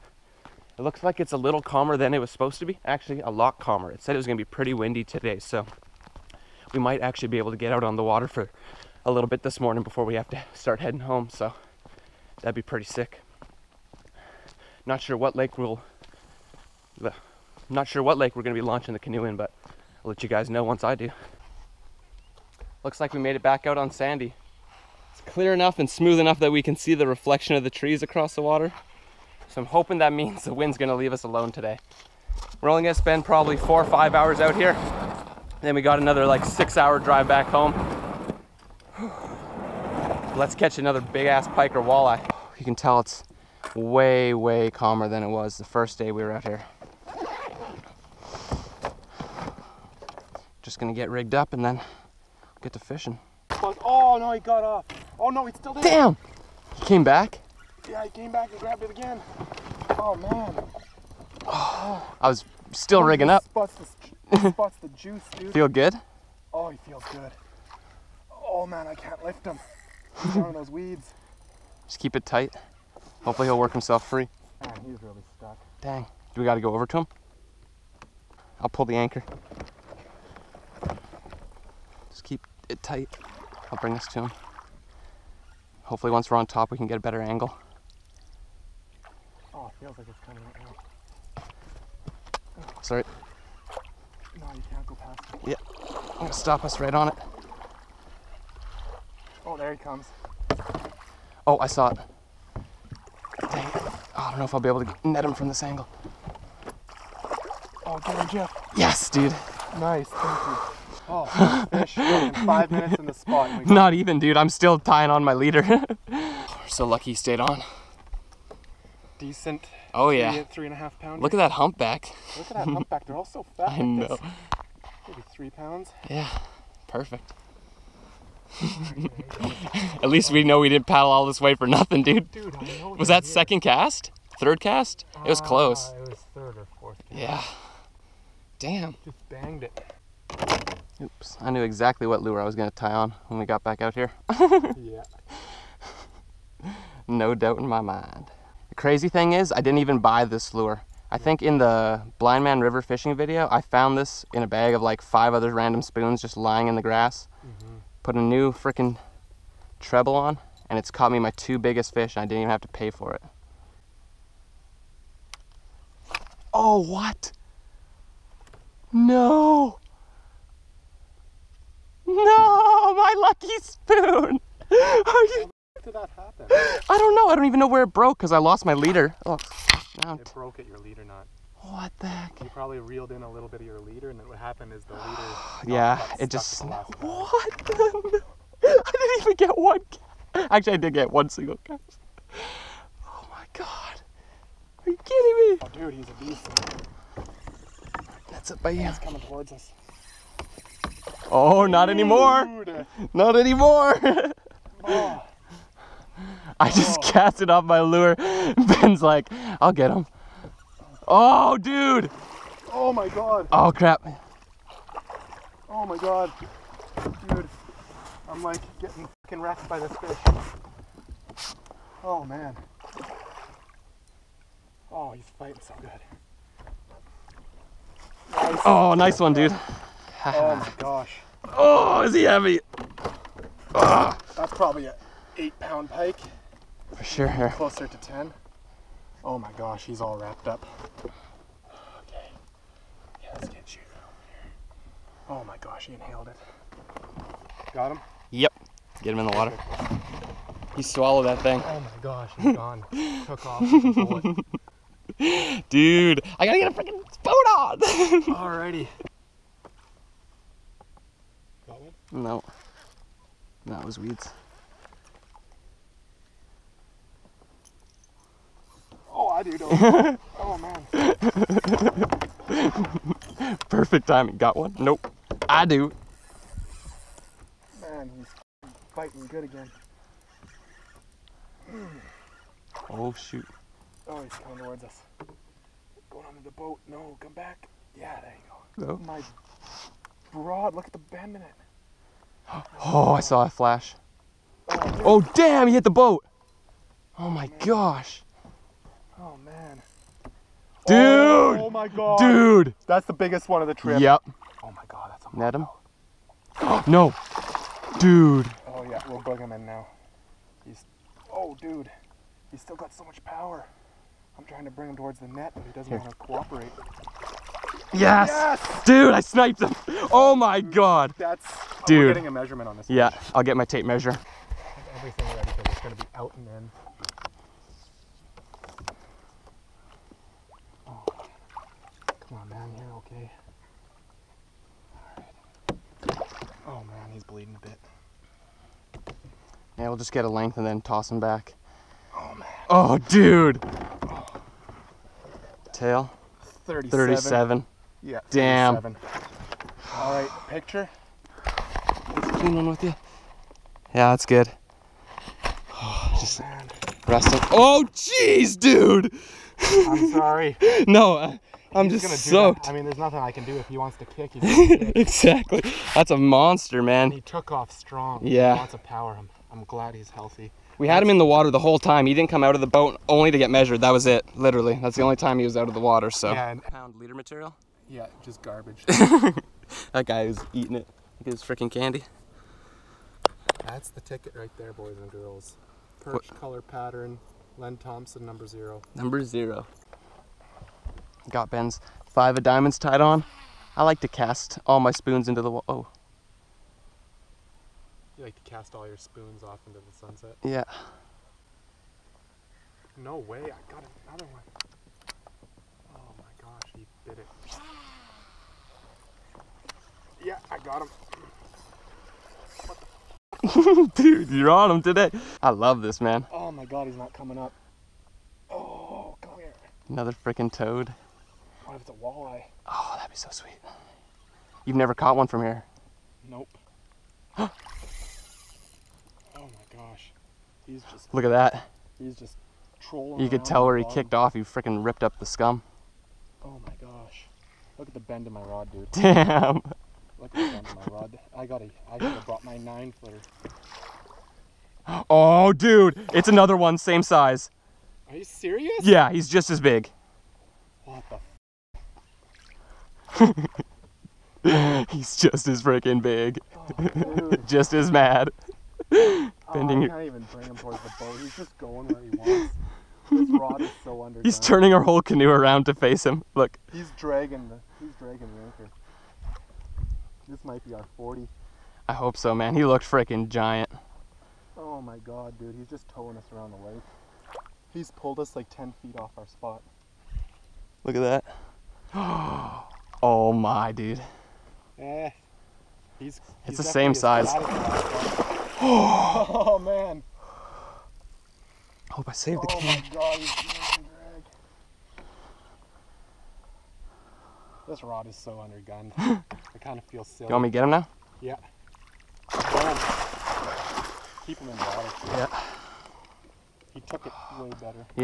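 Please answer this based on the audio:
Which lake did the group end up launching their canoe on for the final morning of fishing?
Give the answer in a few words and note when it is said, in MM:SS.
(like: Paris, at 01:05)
Sandy, at 00:23.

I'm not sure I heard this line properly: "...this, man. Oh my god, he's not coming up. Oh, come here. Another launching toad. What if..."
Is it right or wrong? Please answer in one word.
wrong.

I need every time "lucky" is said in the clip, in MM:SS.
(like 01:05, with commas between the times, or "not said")
01:56, 02:53.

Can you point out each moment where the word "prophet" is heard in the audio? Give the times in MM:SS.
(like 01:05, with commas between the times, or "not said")
not said.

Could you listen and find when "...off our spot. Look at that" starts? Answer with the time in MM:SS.
07:58.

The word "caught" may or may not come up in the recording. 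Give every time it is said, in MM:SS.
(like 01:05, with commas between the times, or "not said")
02:40, 07:04.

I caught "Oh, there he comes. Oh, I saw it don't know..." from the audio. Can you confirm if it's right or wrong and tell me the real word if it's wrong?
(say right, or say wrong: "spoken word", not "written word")
right.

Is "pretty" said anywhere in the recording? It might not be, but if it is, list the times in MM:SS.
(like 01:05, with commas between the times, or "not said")
00:04, 00:12.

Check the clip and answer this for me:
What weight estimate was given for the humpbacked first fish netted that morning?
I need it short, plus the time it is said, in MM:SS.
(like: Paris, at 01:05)
3 to 3.5 pounds, at 02:00.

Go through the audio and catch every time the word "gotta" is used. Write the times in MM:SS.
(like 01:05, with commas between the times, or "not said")
04:16, 07:21.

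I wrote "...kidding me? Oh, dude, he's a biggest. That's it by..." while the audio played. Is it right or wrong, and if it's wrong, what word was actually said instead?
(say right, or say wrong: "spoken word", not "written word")
wrong: "beast", not "biggest".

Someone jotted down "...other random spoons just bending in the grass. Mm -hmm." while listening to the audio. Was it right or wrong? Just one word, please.
wrong.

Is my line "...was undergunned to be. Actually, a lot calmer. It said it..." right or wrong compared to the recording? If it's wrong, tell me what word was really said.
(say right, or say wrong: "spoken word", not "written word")
wrong: "supposed", not "undergunned".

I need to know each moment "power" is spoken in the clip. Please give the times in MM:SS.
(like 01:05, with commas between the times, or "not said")
05:13, 06:08.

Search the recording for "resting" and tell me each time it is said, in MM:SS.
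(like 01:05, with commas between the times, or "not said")
05:57.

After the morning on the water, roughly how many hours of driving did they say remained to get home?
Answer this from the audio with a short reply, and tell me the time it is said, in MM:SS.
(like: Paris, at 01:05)
6 hours, at 00:36.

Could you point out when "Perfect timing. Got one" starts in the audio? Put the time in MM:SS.
04:33.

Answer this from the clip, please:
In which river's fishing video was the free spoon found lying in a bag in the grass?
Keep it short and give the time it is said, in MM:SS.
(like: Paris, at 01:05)
Blindman River, at 02:32.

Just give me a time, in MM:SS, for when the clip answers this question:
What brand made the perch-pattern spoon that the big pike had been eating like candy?
06:27.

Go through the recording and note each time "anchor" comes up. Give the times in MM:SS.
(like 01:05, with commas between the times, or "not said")
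01:18, 07:48.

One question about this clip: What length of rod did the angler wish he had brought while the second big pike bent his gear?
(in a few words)
Nine footer.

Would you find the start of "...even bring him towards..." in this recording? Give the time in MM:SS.
07:40.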